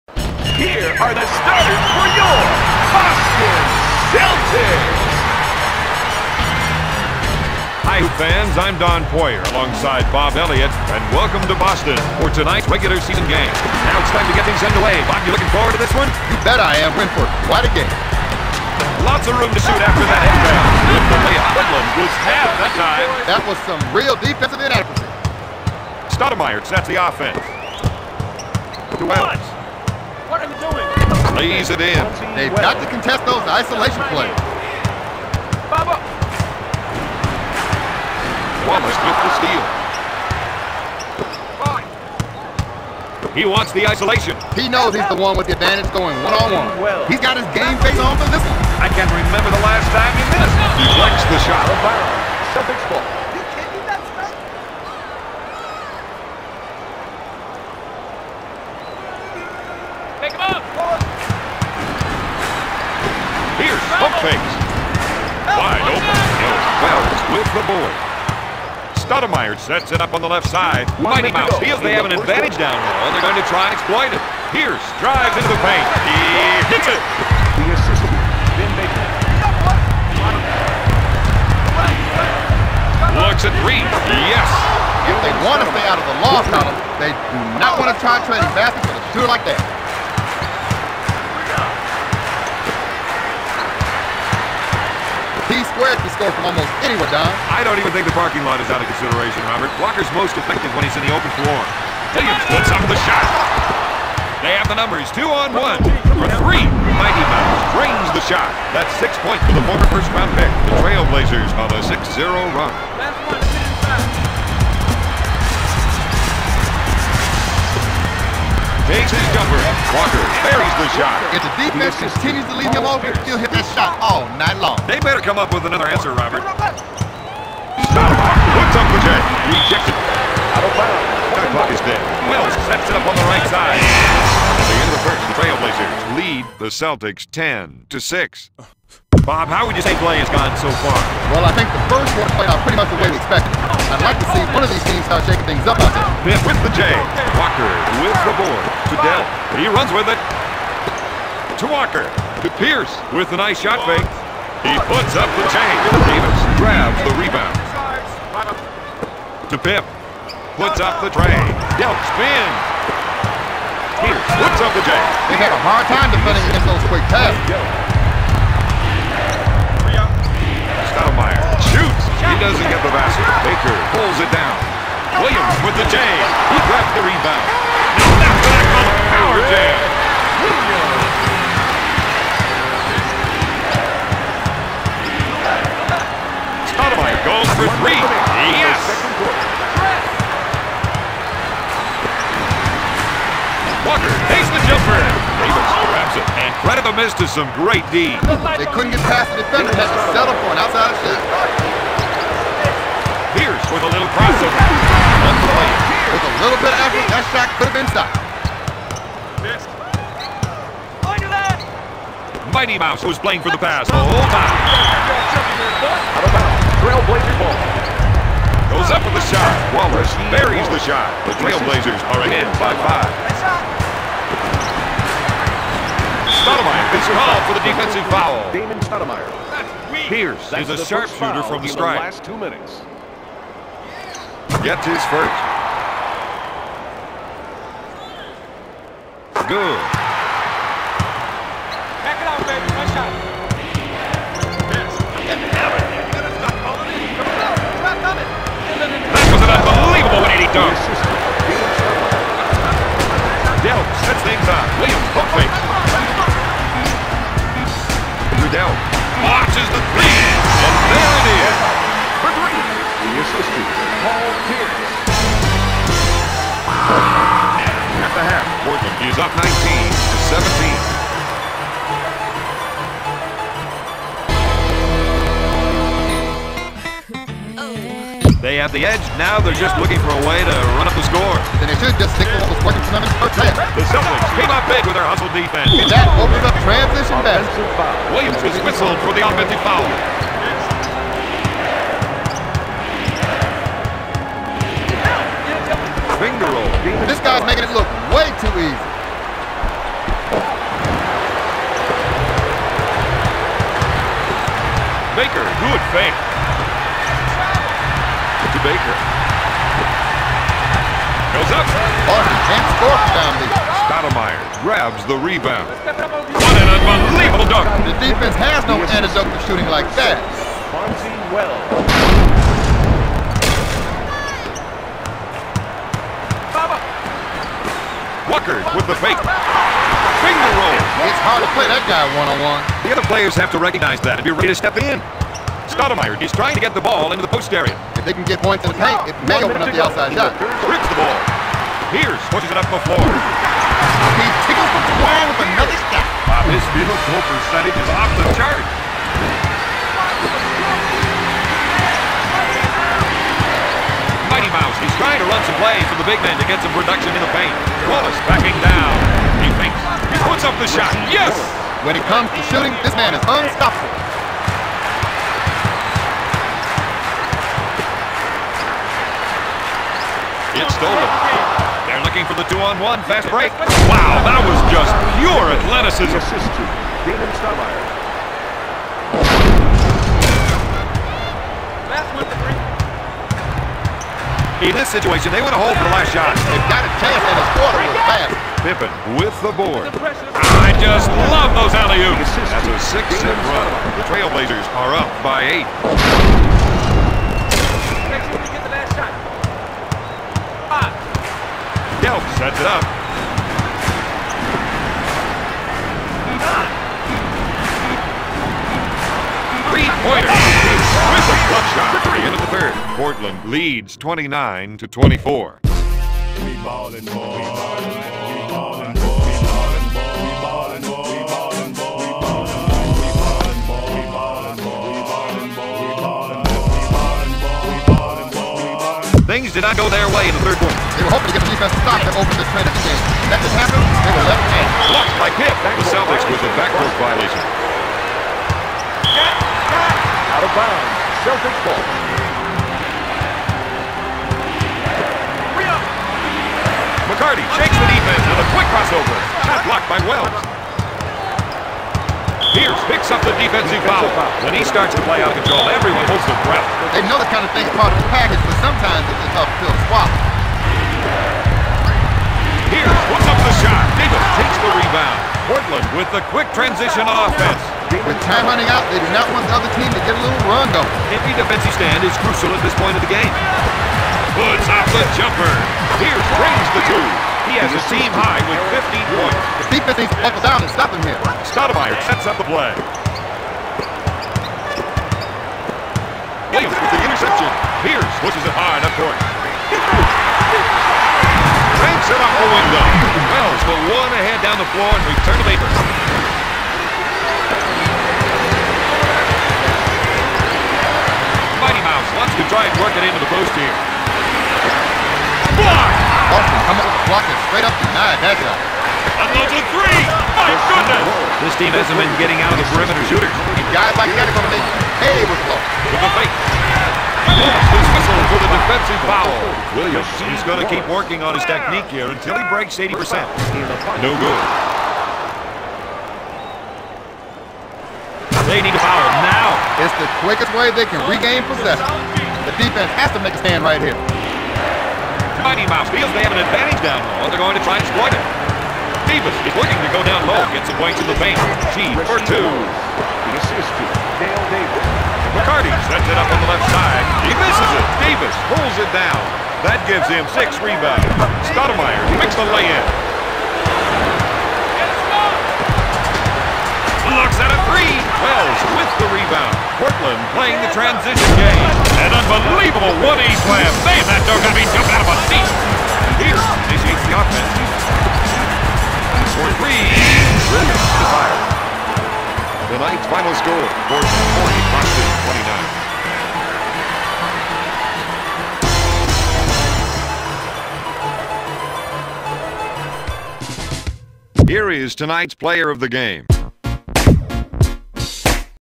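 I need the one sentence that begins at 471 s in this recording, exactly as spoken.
Every defensive stand is crucial at this point of the game.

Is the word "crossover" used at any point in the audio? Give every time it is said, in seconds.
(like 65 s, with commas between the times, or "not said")
204 s, 448 s.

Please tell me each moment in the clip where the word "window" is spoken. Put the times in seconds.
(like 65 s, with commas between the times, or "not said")
492 s.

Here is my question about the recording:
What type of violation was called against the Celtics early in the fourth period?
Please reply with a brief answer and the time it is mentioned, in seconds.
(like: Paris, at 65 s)
Backboard violation, at 436 s.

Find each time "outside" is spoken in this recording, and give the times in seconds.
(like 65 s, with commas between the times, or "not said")
200 s, 339 s.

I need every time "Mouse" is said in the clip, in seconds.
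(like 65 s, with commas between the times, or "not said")
71 s, 107 s, 212 s, 354 s, 501 s, 535 s.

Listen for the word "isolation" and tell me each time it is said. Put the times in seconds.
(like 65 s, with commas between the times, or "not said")
33 s, 43 s.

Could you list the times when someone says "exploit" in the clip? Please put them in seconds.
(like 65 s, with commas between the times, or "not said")
73 s, 537 s.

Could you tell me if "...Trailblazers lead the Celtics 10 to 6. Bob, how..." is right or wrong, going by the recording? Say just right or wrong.
right.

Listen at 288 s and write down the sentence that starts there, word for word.
Williams was whistled for the offensive foul.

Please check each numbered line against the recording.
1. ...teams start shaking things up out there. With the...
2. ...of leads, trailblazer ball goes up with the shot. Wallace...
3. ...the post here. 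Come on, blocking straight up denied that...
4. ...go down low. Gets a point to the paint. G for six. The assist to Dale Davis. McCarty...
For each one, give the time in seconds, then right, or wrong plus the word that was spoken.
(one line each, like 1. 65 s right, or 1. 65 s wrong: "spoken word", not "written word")
1. 144 s right
2. 216 s wrong: "bounds", not "leads"
3. 503 s right
4. 539 s wrong: "two", not "six".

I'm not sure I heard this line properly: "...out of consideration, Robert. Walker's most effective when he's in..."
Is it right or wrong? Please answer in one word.
right.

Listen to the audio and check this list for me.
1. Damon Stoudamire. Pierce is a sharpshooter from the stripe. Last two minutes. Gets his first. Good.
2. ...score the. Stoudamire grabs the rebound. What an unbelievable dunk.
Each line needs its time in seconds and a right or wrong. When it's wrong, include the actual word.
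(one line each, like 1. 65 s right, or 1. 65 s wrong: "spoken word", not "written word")
1. 228 s right
2. 312 s right.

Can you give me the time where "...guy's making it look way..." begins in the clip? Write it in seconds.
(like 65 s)
297 s.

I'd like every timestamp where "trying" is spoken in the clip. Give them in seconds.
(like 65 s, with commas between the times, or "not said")
336 s, 354 s.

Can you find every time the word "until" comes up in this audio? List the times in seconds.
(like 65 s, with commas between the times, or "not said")
522 s.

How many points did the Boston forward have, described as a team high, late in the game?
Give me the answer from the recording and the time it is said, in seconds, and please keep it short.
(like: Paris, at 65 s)
15, at 478 s.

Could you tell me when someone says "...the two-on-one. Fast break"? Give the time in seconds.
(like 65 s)
372 s.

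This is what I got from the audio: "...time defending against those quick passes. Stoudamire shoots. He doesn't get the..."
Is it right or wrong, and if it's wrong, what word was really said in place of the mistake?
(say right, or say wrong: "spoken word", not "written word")
right.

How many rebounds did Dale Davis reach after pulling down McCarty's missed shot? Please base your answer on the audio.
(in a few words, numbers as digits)
6.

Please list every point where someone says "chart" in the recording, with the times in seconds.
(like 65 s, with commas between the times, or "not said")
348 s.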